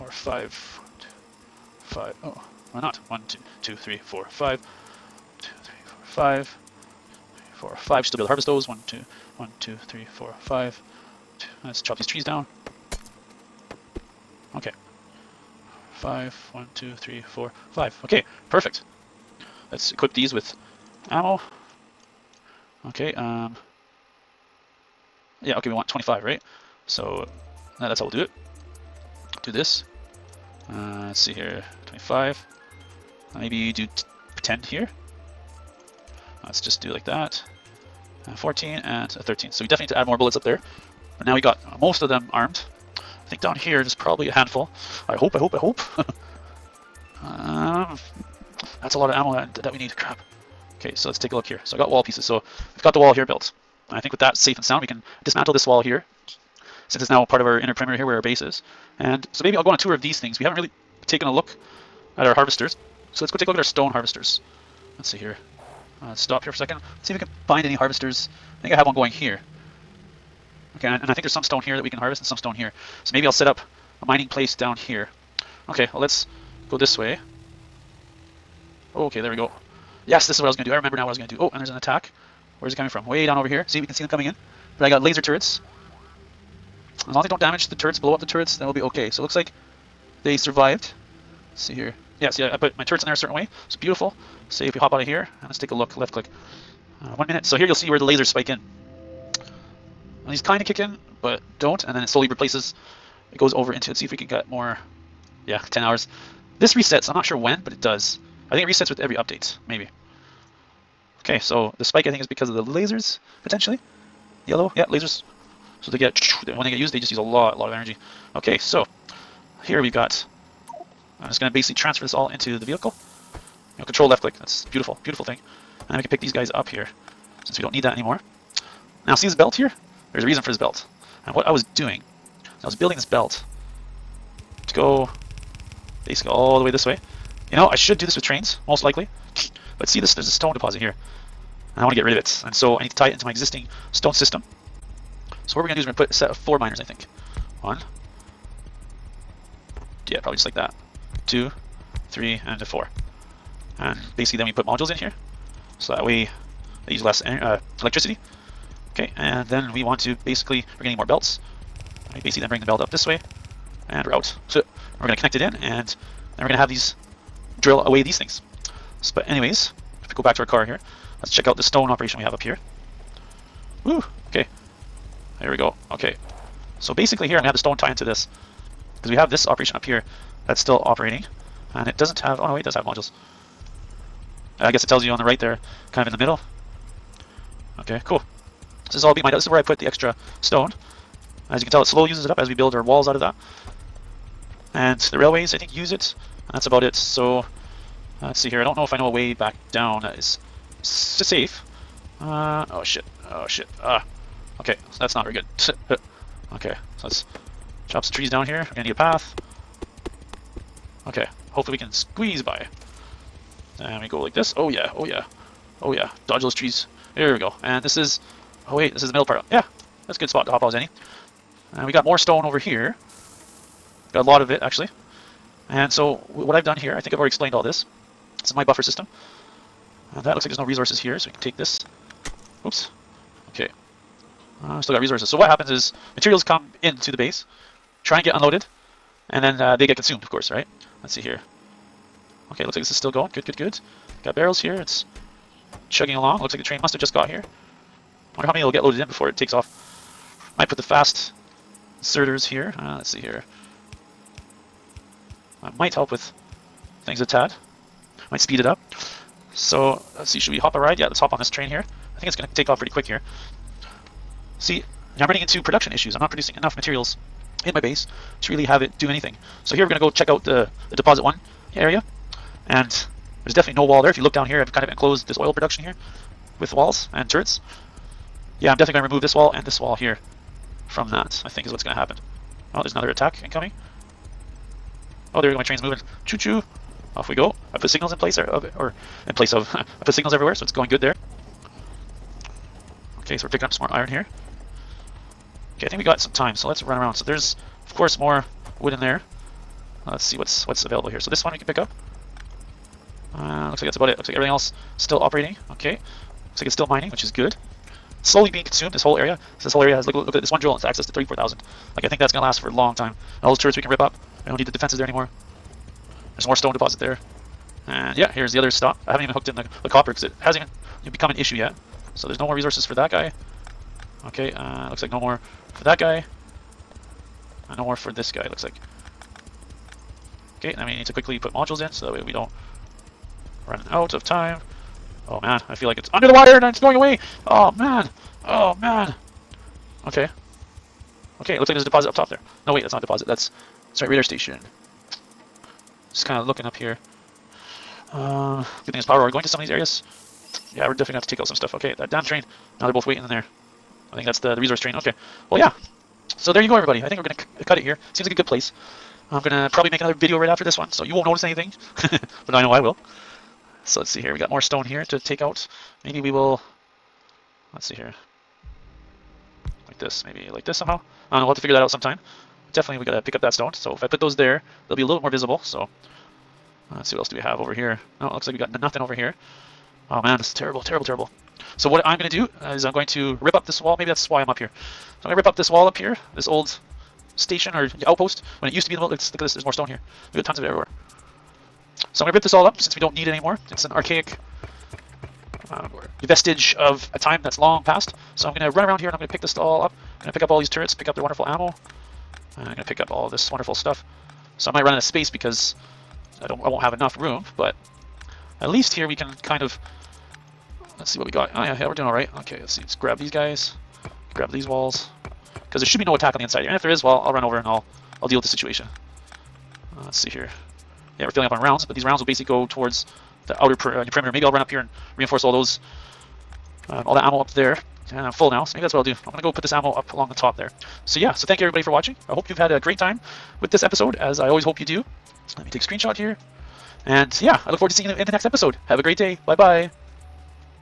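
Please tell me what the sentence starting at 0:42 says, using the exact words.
I think down here there's probably a handful.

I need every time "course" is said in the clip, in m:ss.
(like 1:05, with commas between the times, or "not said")
4:00, 4:57.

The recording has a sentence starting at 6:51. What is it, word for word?
Oh yeah, yeah, we're doing all right.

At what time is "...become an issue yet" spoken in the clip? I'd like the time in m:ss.
5:21.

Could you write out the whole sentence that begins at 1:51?
Okay, so the spike I think is because of the lasers, potentially.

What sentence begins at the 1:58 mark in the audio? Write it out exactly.
Okay, so here we've got, I'm just going to basically transfer this all into the vehicle.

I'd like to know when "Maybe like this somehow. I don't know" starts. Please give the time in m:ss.
6:10.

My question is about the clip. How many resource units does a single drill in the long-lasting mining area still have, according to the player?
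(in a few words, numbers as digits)
34,000.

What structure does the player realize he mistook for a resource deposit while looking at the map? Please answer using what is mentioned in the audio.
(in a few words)
radar station.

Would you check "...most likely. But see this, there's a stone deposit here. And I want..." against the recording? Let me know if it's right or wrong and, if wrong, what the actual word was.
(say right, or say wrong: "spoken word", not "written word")
right.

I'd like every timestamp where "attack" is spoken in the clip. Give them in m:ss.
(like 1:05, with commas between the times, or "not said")
1:21, 4:43, 6:56.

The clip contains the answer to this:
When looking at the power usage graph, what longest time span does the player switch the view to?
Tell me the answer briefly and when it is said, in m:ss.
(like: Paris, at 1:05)
10 hours, at 1:45.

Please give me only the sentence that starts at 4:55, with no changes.
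Okay, I think we got some time, so let's run around.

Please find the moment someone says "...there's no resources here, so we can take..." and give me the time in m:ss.
3:50.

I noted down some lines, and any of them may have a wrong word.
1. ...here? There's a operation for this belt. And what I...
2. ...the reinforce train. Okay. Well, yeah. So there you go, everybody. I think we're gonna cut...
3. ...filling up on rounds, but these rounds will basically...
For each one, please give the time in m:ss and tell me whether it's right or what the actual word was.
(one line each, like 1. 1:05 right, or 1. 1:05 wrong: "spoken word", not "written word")
1. 2:09 wrong: "reason", not "operation"
2. 5:54 wrong: "resource", not "reinforce"
3. 7:01 right.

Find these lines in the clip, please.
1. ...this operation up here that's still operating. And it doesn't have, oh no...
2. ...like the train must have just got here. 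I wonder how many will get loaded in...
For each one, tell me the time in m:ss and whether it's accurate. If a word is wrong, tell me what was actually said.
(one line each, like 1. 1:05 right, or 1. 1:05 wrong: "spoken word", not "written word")
1. 2:59 right
2. 4:06 right.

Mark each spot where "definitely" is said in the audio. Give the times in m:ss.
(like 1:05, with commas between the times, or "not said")
0:39, 4:33, 4:38, 5:50, 6:12.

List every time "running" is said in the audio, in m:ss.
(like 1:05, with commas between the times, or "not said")
4:25, 5:33.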